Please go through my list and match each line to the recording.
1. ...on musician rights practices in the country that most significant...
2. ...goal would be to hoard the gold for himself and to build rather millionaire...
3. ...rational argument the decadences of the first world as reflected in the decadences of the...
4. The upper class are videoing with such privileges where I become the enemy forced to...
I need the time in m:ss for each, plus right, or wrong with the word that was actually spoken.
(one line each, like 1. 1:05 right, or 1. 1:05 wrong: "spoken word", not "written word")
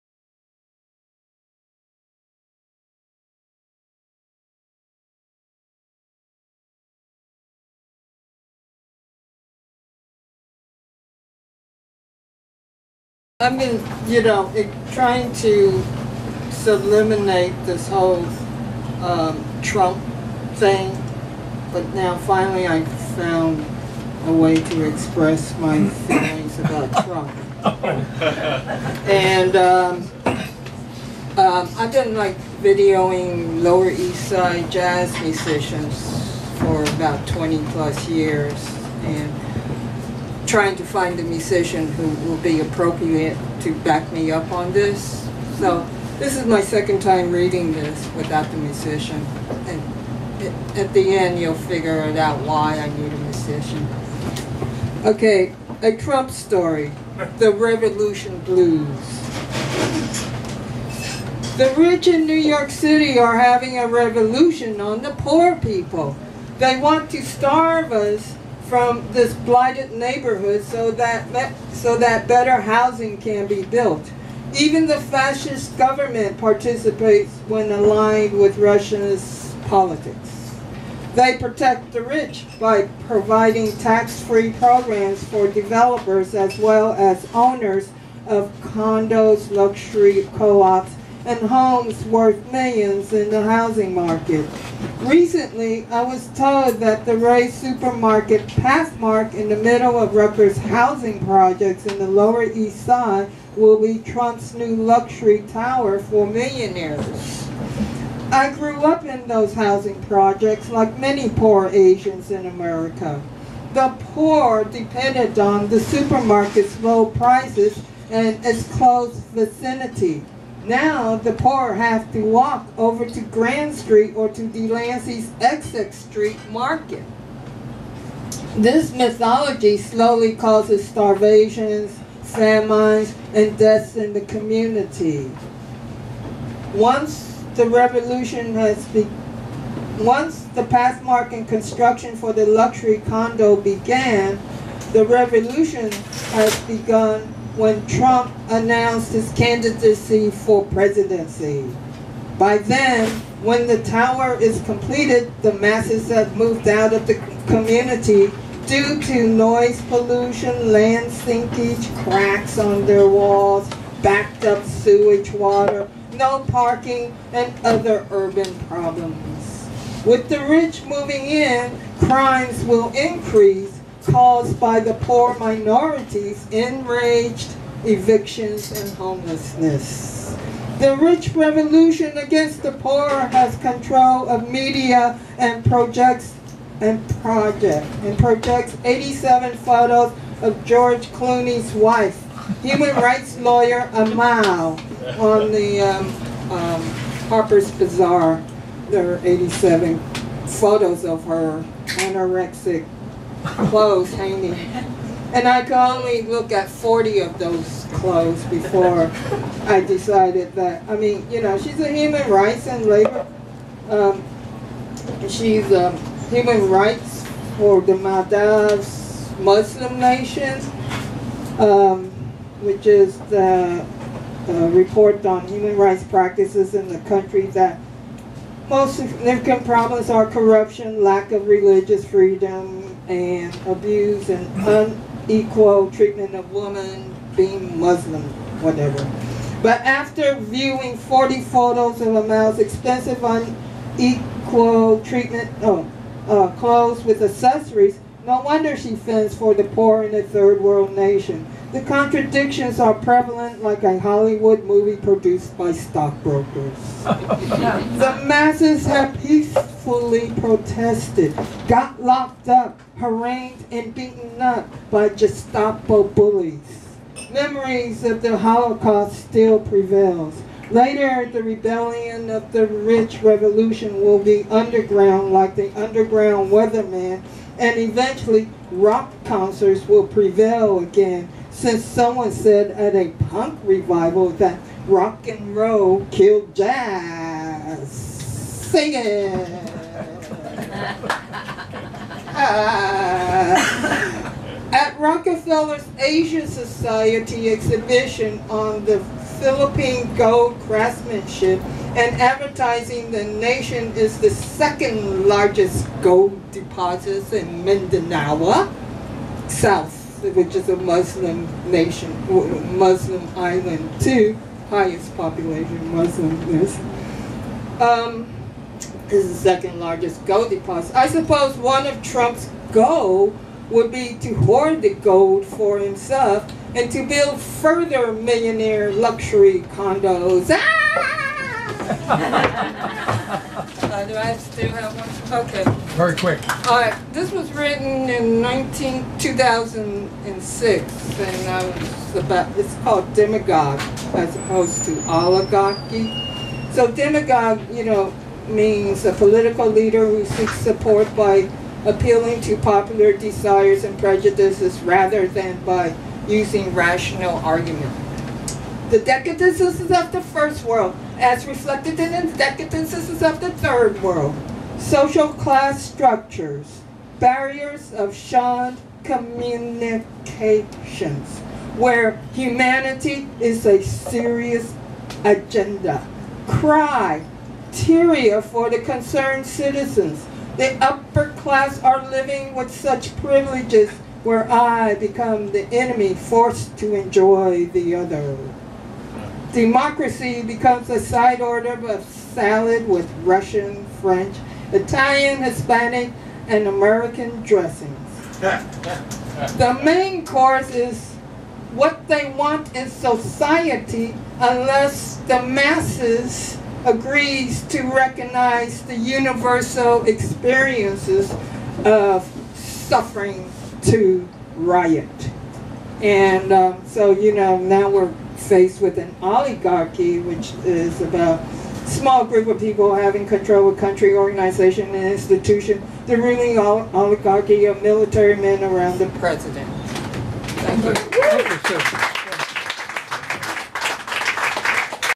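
1. 3:45 wrong: "human", not "musician"
2. 5:22 wrong: "further", not "rather"
3. 5:56 right
4. 6:20 wrong: "living", not "videoing".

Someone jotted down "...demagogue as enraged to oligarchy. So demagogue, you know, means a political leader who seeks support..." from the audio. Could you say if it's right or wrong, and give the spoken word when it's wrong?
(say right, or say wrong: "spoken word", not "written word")
wrong: "opposed", not "enraged".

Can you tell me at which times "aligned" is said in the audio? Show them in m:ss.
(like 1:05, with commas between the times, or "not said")
1:17.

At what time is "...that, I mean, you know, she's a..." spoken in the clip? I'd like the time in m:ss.
3:30.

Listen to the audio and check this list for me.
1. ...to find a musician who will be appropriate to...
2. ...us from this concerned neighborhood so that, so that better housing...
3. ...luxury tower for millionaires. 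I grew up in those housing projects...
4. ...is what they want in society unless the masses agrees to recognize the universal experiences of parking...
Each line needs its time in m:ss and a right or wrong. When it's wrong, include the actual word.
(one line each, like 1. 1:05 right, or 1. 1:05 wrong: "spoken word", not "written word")
1. 0:40 right
2. 1:07 wrong: "blighted", not "concerned"
3. 1:44 right
4. 6:40 wrong: "suffering", not "parking".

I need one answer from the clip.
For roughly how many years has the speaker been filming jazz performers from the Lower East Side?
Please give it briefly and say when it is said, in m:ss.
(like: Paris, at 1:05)
20, at 0:37.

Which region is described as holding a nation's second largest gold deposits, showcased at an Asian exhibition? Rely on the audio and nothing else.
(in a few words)
Mindanao.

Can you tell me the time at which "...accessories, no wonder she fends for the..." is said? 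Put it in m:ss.
4:07.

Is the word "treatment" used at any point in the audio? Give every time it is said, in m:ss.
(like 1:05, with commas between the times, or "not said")
3:55, 4:05.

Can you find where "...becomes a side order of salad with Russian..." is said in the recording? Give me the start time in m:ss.
6:30.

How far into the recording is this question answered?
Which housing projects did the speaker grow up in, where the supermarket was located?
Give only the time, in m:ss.
1:40.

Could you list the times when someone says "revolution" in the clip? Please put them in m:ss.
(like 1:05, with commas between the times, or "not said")
0:57, 1:03, 2:17, 2:25, 3:01, 4:33.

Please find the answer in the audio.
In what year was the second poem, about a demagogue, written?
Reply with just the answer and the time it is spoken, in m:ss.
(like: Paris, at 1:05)
2006, at 5:39.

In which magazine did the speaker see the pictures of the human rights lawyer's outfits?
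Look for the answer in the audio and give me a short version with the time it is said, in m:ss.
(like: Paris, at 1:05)
Harper's Bazaar, at 3:17.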